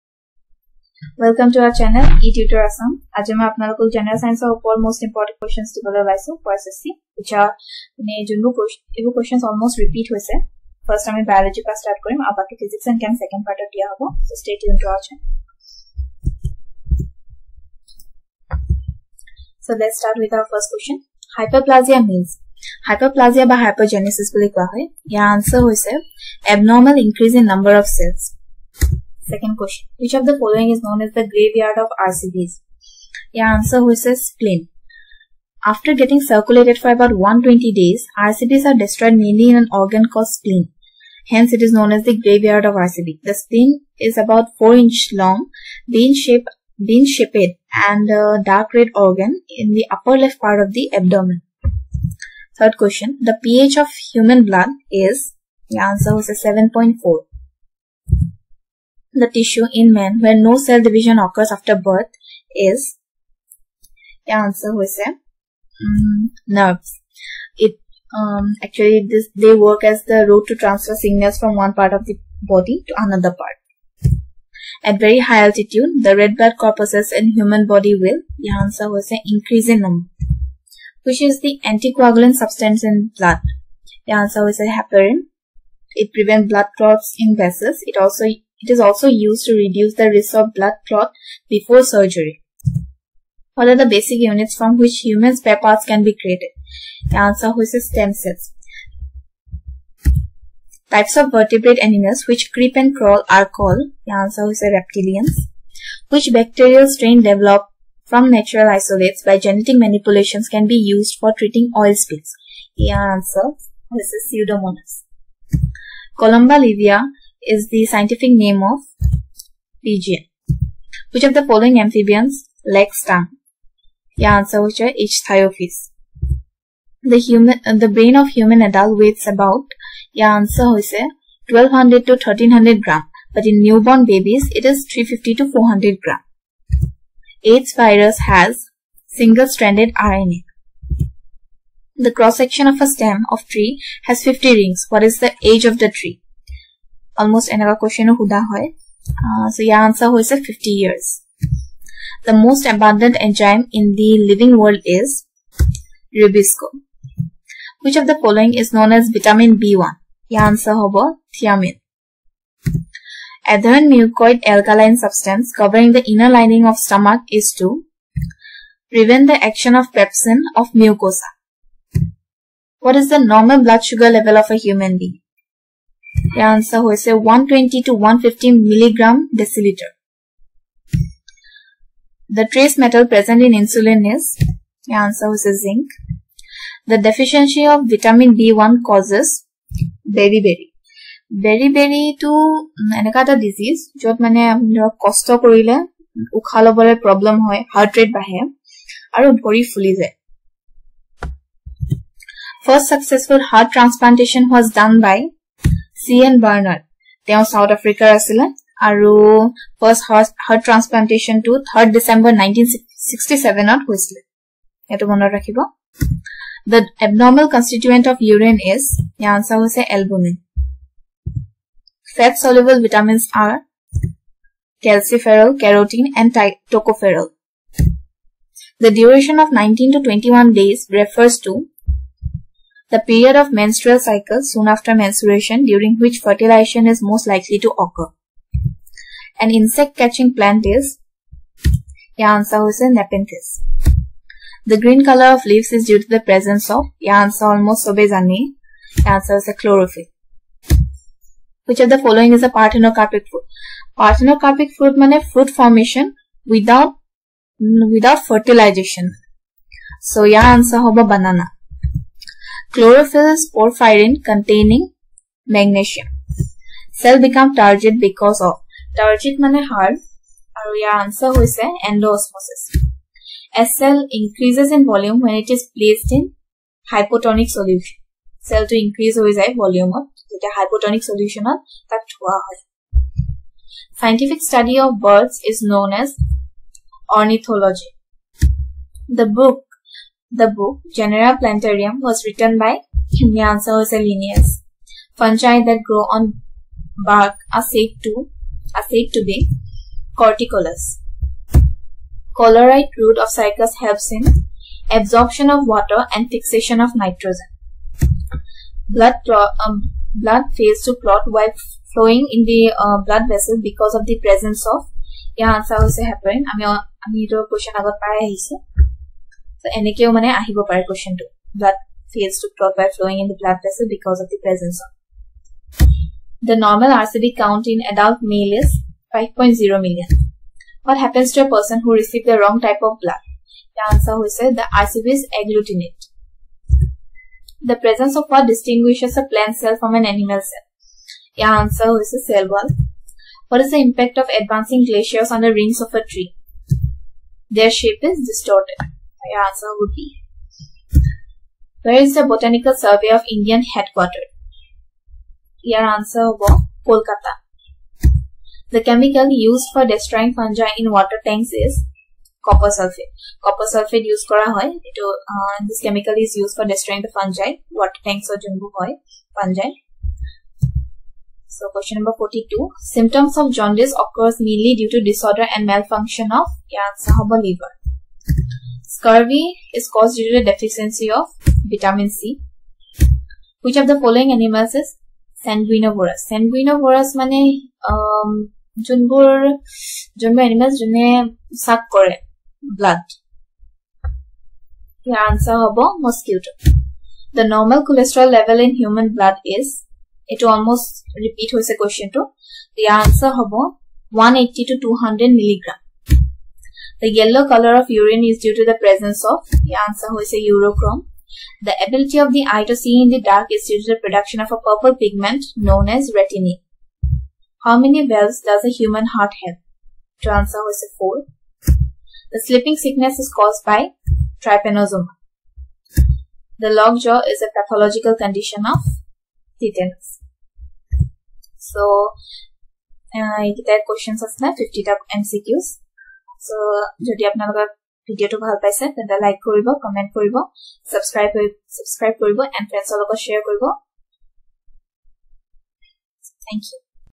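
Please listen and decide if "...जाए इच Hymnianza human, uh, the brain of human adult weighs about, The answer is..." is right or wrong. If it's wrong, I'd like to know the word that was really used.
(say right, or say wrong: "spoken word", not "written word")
wrong: "The", not "Hymnianza".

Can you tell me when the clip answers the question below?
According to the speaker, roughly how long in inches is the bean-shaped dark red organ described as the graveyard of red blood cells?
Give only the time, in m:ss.
0:44.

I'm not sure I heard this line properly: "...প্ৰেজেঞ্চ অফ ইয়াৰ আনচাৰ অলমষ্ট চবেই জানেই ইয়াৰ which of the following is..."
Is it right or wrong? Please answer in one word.
right.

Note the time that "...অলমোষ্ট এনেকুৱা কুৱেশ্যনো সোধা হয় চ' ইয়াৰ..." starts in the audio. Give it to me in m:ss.
2:27.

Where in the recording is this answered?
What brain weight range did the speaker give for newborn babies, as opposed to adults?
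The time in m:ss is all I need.
2:14.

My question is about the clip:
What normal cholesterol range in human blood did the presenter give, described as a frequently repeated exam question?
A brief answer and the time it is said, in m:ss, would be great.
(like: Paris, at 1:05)
180 to 200 milligrams, at 6:44.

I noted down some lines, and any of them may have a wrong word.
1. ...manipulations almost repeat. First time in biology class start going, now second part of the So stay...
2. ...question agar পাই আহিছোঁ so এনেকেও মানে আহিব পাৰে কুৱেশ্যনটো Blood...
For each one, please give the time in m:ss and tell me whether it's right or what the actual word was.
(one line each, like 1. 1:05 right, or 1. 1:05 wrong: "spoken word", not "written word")
1. 0:09 wrong: "questions", not "manipulations"
2. 5:17 right.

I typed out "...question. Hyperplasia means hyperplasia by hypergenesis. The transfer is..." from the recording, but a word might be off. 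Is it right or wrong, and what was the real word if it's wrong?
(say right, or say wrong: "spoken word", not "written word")
wrong: "answer", not "transfer".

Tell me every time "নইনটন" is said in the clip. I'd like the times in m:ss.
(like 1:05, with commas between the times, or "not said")
3:32, 3:49.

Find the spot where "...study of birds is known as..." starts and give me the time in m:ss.
4:44.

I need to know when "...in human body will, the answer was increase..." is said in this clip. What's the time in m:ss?
1:17.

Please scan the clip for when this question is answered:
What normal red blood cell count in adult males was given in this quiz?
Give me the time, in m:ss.
5:29.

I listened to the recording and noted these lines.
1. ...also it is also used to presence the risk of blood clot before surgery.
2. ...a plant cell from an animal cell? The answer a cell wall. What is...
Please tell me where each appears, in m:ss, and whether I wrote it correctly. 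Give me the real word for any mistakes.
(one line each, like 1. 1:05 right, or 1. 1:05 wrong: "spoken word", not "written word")
1. 1:28 wrong: "reduce", not "presence"
2. 5:39 right.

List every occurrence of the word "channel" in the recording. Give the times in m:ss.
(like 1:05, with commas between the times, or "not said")
0:01, 0:15.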